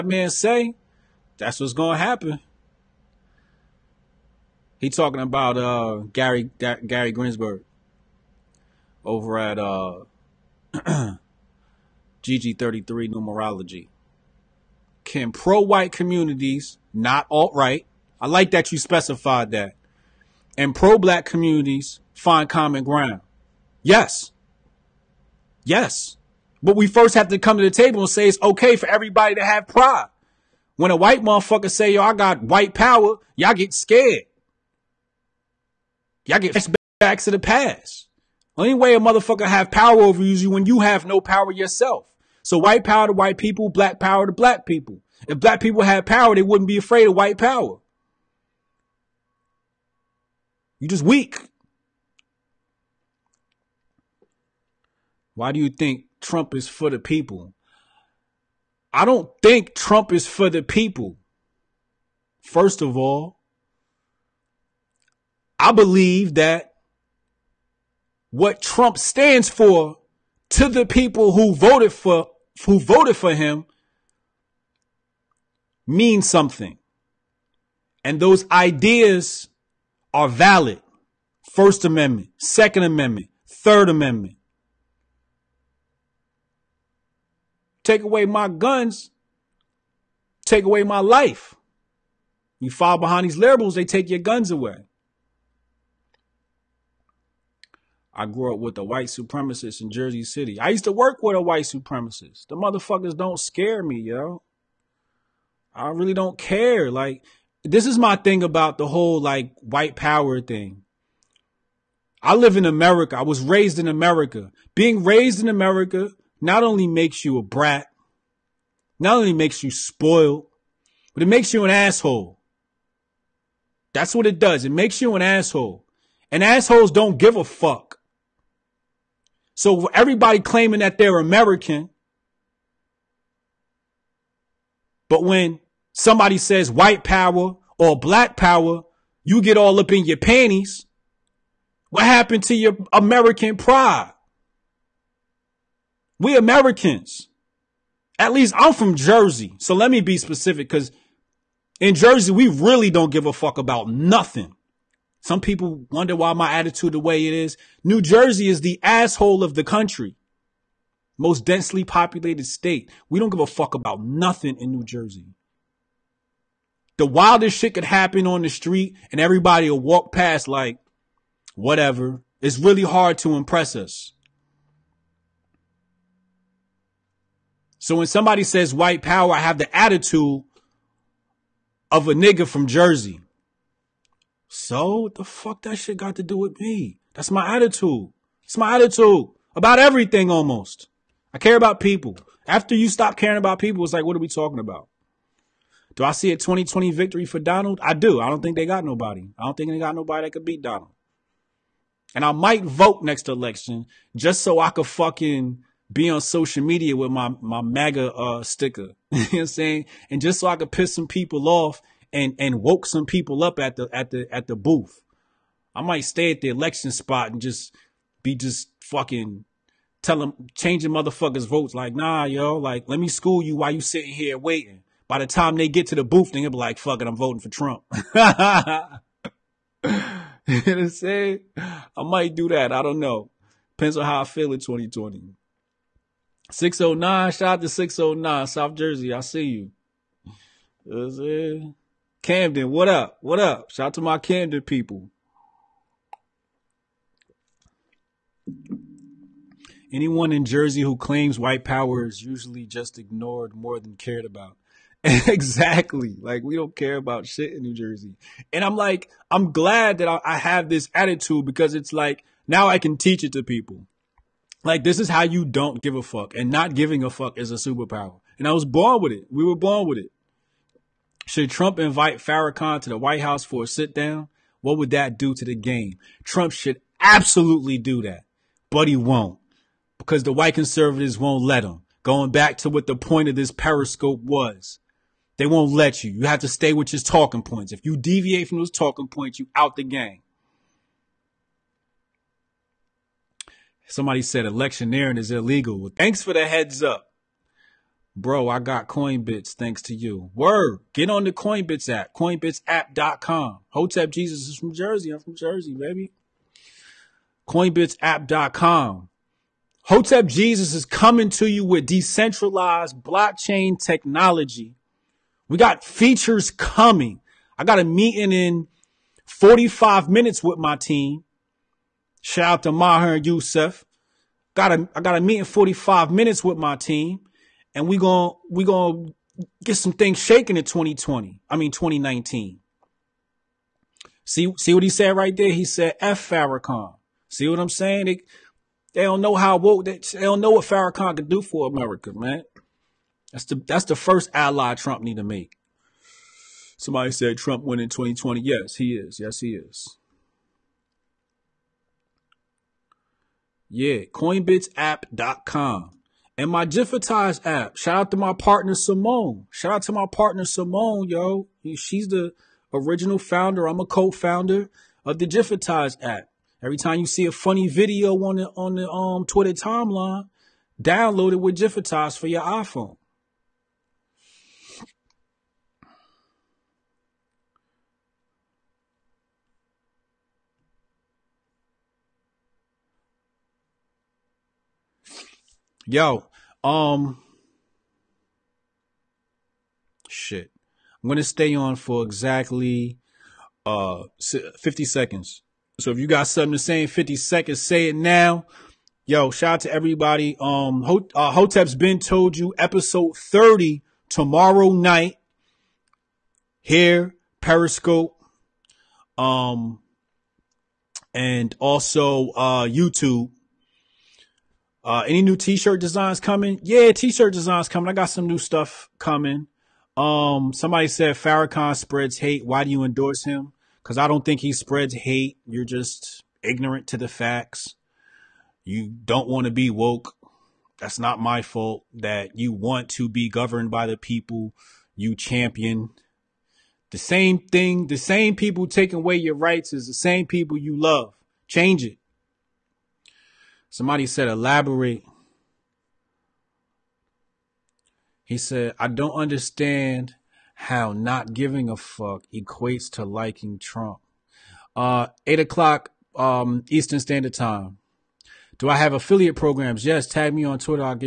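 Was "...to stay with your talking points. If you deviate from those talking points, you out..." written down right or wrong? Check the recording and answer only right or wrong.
right.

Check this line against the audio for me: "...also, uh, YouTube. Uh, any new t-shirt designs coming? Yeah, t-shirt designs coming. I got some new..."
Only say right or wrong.
right.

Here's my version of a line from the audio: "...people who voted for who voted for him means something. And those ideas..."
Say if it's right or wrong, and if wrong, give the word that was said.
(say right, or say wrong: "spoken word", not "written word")
right.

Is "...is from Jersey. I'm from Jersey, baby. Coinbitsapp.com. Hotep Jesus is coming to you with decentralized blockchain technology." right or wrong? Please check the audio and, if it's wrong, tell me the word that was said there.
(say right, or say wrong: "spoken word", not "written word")
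right.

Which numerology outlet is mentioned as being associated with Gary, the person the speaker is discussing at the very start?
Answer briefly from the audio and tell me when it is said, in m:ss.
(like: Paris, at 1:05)
GG33 Numerology, at 0:12.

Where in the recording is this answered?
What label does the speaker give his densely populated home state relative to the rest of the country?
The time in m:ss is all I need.
2:38.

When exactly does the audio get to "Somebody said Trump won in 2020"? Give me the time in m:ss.
5:46.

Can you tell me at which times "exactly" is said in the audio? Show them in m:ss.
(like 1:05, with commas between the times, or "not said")
4:15, 6:32.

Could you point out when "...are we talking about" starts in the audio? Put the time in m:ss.
3:14.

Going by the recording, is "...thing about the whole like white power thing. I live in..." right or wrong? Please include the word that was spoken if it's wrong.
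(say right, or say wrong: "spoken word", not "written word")
right.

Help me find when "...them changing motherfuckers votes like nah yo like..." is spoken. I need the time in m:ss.
3:40.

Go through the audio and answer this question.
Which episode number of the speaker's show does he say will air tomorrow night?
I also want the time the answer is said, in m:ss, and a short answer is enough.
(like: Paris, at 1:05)
30, at 6:42.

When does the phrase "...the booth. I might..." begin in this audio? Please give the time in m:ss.
3:34.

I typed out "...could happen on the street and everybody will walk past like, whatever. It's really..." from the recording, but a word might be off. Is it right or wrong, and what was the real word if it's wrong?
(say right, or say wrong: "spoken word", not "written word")
right.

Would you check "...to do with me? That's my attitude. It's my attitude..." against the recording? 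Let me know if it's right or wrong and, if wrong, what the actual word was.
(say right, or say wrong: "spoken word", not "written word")
right.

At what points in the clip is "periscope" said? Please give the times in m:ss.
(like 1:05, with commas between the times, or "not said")
4:43, 6:47.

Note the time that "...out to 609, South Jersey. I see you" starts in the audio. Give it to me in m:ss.
3:57.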